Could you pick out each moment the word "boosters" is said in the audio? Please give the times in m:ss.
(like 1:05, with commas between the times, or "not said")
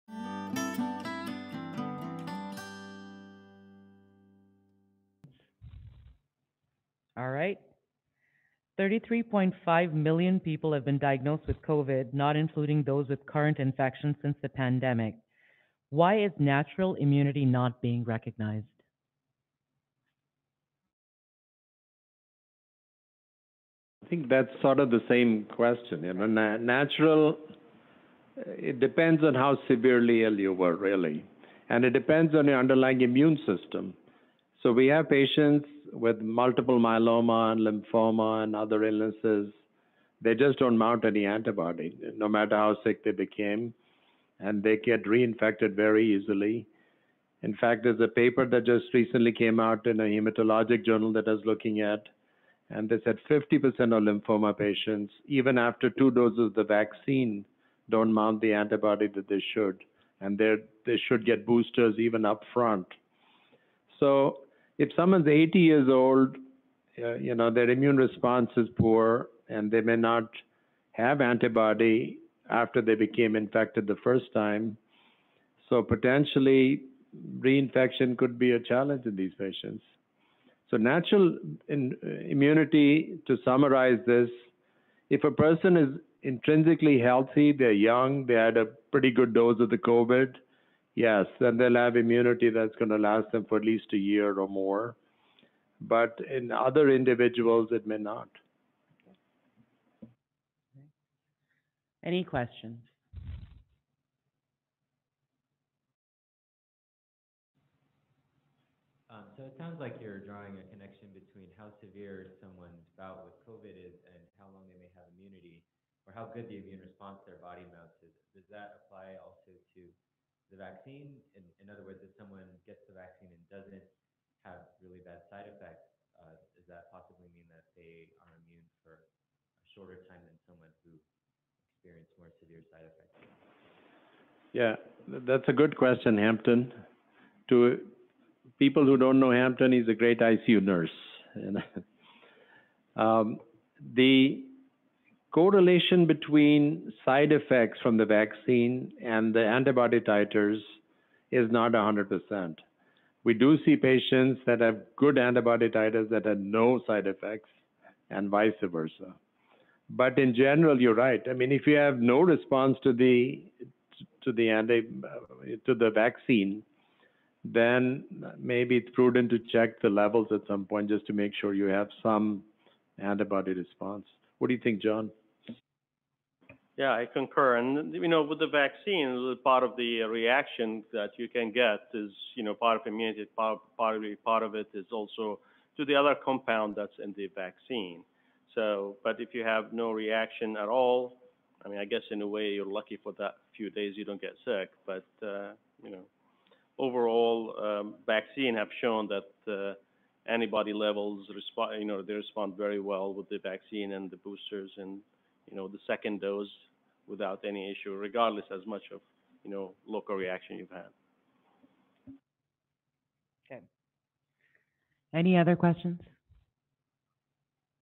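1:01, 3:24.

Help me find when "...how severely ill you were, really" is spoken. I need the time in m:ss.
0:29.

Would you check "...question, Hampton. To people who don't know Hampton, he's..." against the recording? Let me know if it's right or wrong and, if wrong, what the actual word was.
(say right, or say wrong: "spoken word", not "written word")
right.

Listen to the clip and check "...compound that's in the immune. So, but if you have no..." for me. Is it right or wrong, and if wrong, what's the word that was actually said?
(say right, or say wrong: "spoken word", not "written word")
wrong: "vaccine", not "immune".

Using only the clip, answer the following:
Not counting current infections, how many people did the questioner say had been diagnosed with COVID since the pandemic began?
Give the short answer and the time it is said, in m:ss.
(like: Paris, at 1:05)
33.5 million, at 0:08.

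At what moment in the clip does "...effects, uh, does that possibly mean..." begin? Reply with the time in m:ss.
2:05.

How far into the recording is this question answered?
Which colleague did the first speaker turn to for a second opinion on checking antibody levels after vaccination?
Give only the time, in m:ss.
2:54.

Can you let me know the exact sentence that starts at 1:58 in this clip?
Does that apply also to the vaccine.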